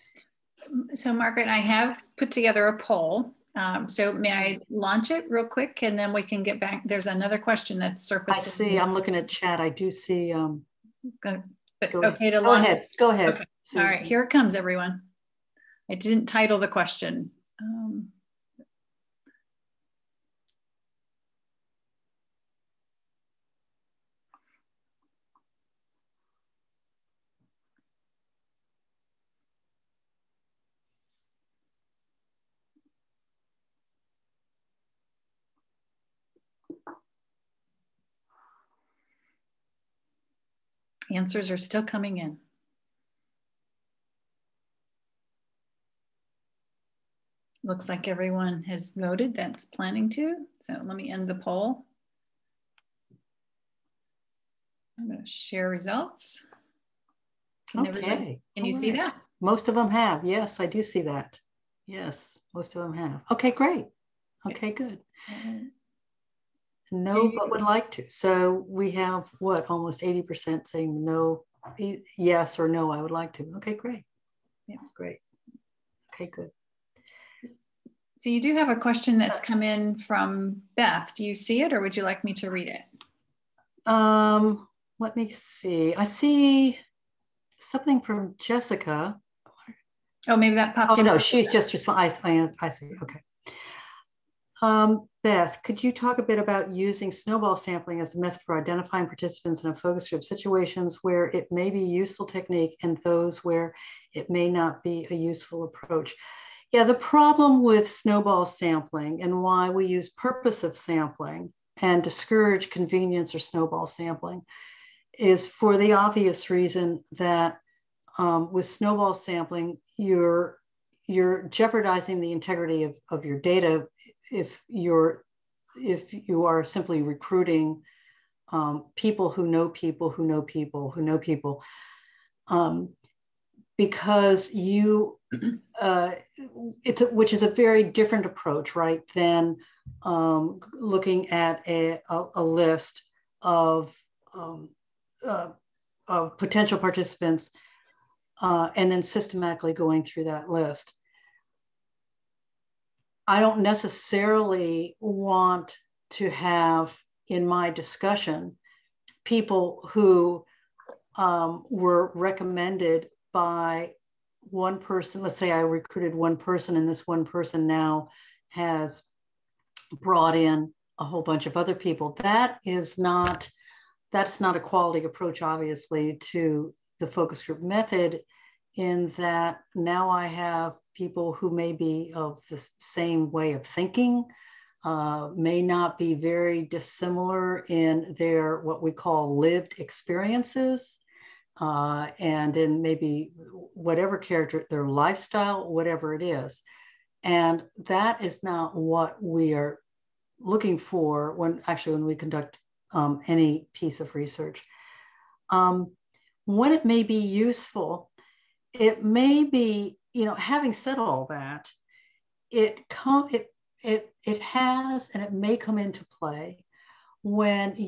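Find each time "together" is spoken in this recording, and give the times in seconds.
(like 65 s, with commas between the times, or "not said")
2 s.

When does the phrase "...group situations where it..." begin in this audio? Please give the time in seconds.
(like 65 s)
100 s.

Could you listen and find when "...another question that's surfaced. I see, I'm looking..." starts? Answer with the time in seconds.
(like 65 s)
7 s.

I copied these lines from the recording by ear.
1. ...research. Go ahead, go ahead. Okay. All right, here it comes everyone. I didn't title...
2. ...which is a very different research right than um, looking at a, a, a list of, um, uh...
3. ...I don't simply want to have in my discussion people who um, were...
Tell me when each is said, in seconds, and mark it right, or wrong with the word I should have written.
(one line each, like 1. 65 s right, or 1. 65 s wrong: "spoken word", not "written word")
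1. 12 s wrong: "launch", not "research"
2. 137 s wrong: "approach", not "research"
3. 153 s wrong: "necessarily", not "simply".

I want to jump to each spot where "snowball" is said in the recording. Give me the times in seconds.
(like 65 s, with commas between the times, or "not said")
97 s, 107 s, 113 s, 118 s.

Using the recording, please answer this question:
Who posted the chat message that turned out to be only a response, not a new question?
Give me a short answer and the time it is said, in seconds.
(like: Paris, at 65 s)
Jessica, at 88 s.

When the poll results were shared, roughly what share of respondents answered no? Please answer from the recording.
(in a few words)
80%.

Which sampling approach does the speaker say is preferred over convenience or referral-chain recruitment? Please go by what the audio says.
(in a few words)
purposive sampling.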